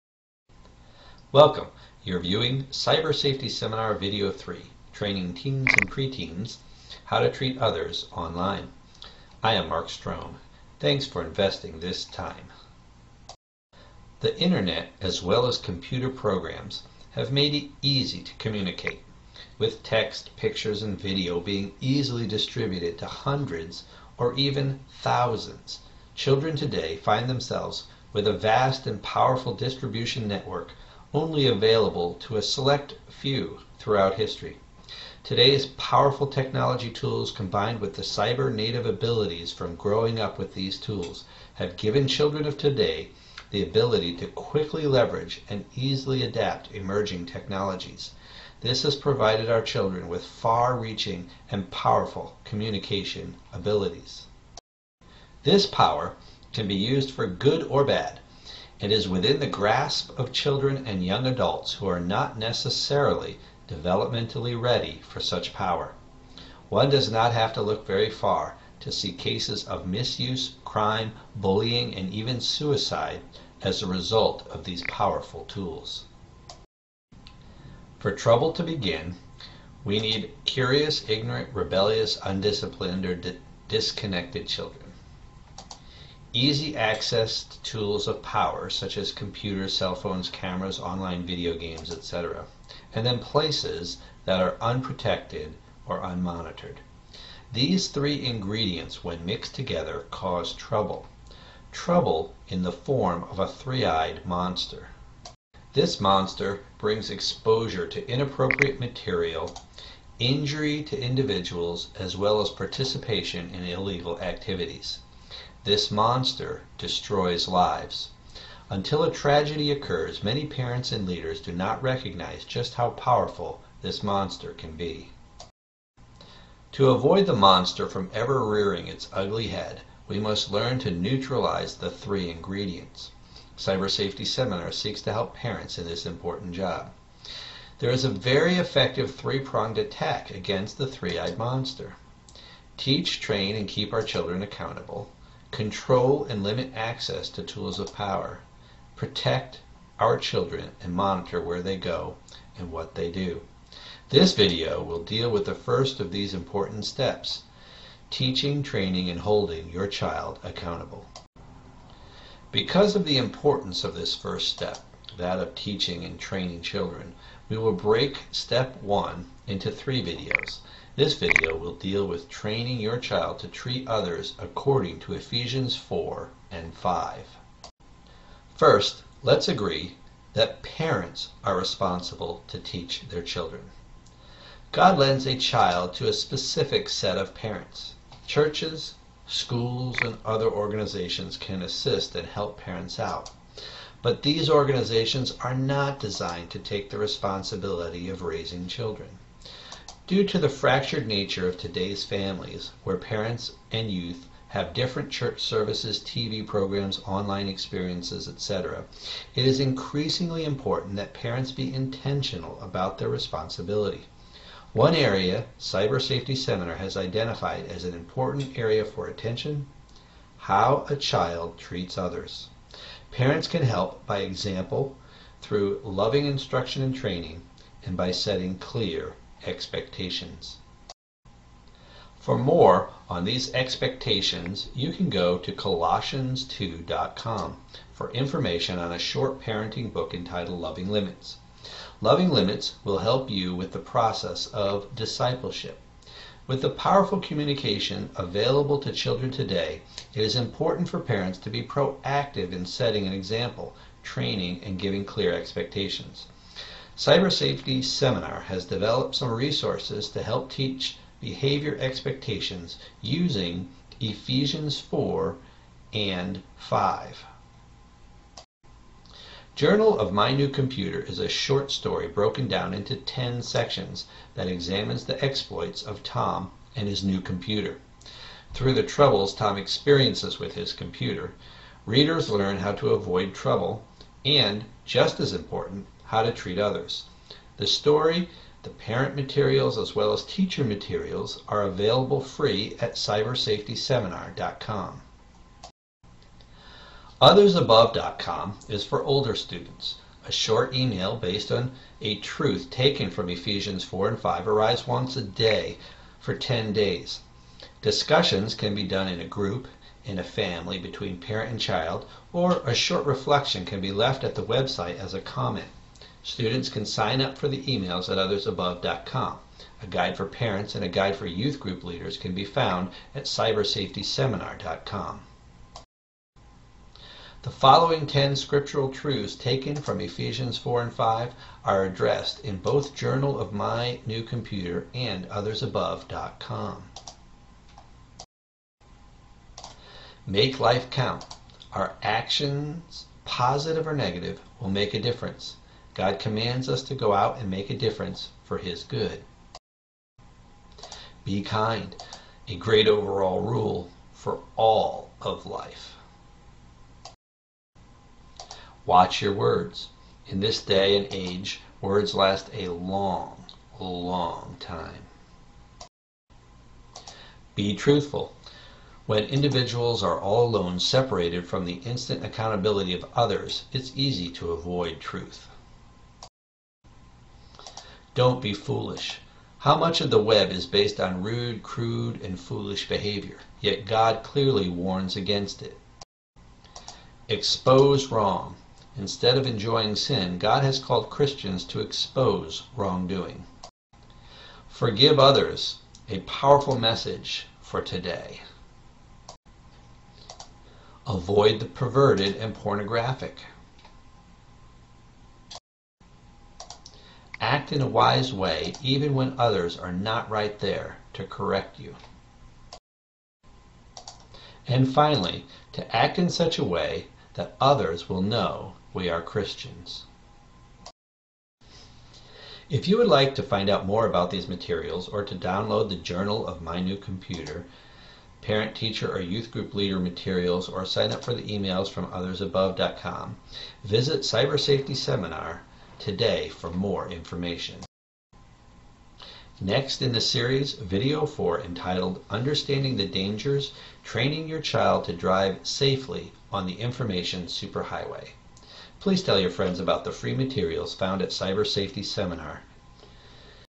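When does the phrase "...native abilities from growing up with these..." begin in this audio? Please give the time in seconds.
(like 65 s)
38 s.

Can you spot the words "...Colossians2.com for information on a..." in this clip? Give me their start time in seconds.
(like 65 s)
235 s.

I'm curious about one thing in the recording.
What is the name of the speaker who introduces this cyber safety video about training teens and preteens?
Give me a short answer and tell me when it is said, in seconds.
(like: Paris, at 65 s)
Mark Strohm, at 9 s.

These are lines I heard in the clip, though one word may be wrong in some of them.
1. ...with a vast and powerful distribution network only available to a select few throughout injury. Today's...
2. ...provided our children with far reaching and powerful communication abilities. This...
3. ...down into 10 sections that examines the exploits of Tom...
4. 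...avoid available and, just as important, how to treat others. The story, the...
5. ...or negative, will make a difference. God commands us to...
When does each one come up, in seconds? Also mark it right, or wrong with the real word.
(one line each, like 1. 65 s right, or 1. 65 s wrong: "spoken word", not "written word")
1. 28 s wrong: "history", not "injury"
2. 48 s right
3. 272 s right
4. 282 s wrong: "trouble", not "available"
5. 343 s right.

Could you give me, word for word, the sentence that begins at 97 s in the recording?
These three ingredients, when mixed together, cause trouble.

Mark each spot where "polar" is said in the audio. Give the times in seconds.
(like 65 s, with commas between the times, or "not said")
not said.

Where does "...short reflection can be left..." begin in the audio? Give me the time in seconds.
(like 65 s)
312 s.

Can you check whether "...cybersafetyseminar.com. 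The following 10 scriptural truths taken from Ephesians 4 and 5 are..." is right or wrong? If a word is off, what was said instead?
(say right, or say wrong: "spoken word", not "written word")
right.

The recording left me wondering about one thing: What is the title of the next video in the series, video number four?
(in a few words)
Understanding the Dangers.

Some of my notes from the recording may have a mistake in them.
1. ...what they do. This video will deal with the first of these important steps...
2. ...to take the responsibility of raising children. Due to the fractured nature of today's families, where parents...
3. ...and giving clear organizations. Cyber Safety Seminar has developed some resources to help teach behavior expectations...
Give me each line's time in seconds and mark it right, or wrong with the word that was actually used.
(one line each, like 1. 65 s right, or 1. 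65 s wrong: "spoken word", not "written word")
1. 152 s right
2. 196 s right
3. 254 s wrong: "expectations", not "organizations".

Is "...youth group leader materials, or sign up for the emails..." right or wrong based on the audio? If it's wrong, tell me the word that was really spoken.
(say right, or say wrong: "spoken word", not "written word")
right.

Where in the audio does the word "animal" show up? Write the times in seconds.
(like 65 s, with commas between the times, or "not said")
not said.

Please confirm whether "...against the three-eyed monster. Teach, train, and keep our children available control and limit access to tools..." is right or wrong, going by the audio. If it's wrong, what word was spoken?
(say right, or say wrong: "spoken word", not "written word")
wrong: "accountable", not "available".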